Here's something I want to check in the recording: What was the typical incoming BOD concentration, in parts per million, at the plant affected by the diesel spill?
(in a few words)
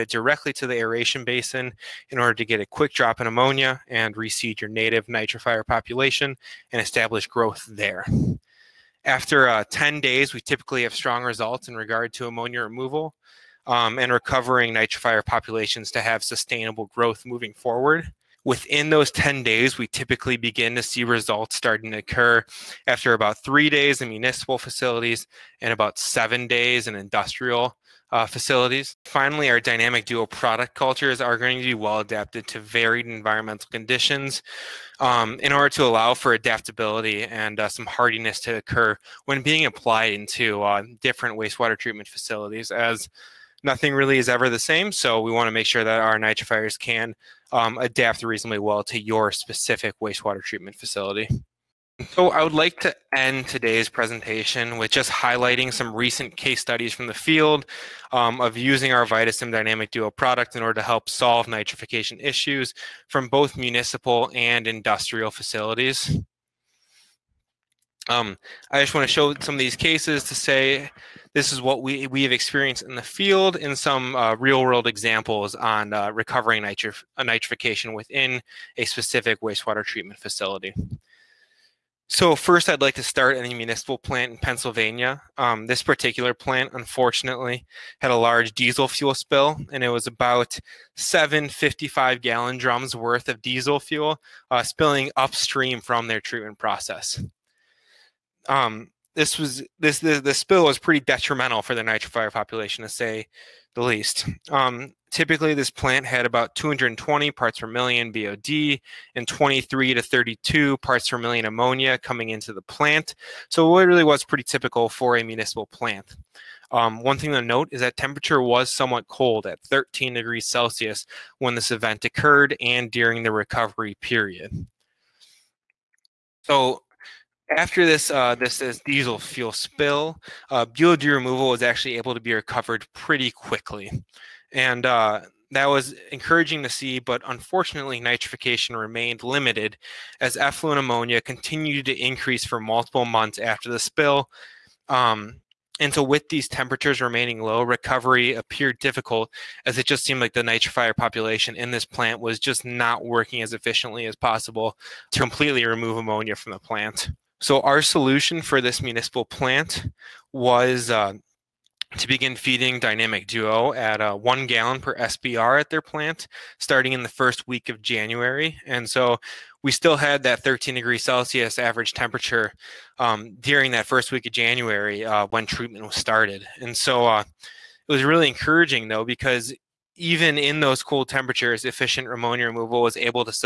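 220.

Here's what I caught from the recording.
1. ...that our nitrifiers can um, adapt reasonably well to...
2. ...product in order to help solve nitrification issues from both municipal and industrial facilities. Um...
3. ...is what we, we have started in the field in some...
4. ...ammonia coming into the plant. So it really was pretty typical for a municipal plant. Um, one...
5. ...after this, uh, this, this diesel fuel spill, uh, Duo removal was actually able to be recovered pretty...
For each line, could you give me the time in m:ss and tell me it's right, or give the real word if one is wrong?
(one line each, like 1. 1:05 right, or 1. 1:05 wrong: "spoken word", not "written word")
1. 0:45 right
2. 1:00 right
3. 1:11 wrong: "experienced", not "started"
4. 1:51 right
5. 2:07 wrong: "BOD", not "Duo".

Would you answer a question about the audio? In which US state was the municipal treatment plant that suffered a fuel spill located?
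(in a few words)
Pennsylvania.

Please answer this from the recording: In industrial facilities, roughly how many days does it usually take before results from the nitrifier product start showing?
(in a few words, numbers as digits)
7 days.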